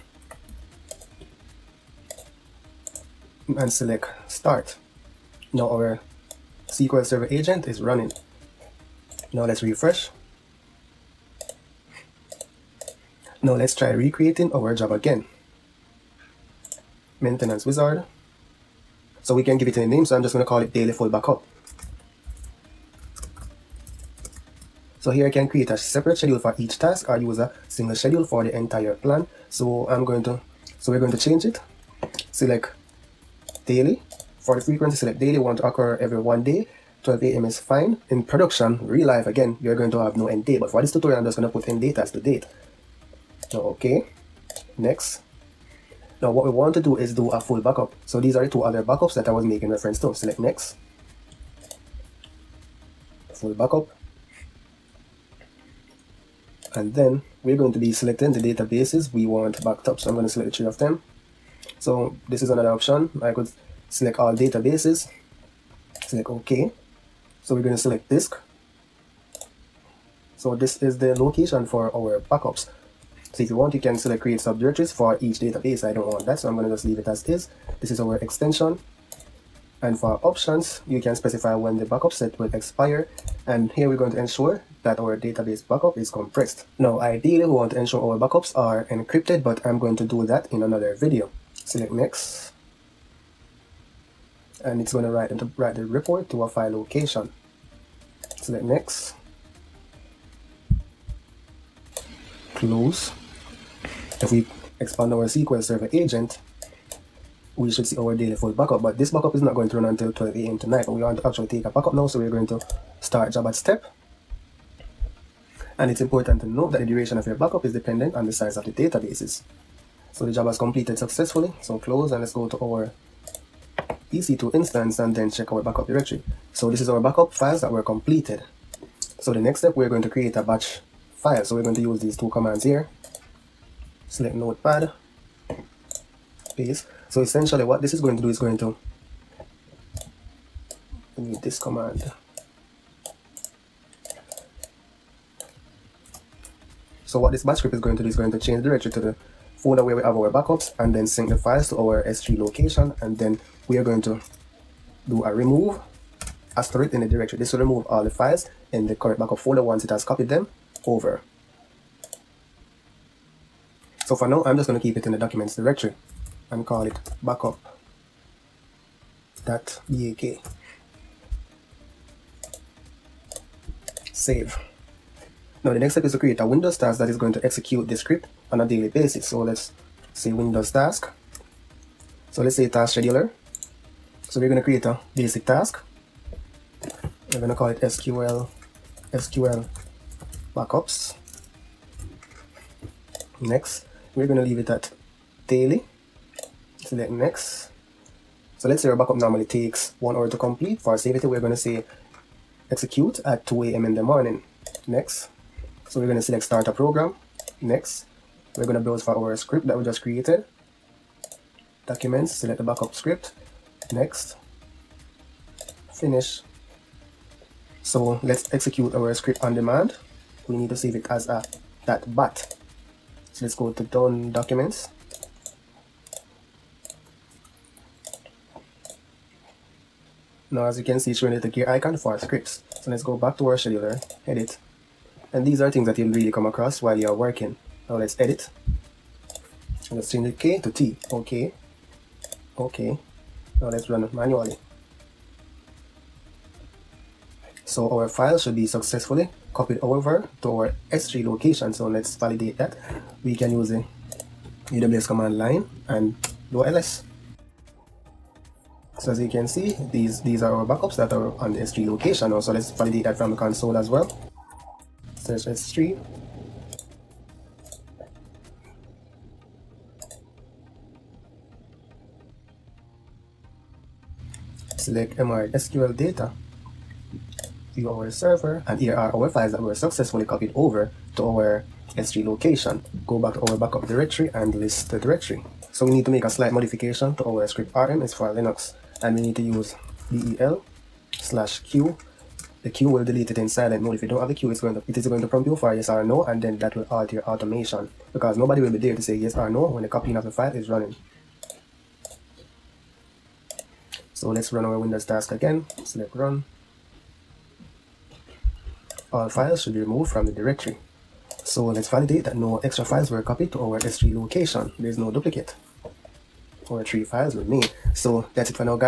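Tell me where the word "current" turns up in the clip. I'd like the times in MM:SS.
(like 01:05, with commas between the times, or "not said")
02:38.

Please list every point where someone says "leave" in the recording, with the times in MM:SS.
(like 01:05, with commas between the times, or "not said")
01:16, 03:14.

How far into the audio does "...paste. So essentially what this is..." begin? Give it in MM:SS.
02:16.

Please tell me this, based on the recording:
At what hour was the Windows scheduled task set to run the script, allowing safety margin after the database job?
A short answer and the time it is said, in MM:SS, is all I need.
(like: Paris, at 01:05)
2 a.m., at 03:23.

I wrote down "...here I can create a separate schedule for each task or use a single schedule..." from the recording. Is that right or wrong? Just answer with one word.
right.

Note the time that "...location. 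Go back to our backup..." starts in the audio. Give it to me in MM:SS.
04:42.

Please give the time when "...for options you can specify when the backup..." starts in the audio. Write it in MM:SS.
01:19.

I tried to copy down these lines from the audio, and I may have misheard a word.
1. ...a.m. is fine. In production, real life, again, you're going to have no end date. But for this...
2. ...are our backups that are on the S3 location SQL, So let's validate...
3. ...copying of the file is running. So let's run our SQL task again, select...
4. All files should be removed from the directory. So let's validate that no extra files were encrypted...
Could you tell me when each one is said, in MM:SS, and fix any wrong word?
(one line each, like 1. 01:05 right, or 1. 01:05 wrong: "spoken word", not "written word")
1. 00:37 right
2. 04:20 wrong: "Also", not "SQL"
3. 04:59 wrong: "Windows", not "SQL"
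4. 05:09 wrong: "copied", not "encrypted".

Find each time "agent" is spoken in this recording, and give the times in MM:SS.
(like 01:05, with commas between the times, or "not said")
00:07, 01:45.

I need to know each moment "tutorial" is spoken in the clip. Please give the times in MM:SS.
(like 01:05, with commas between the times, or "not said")
00:40.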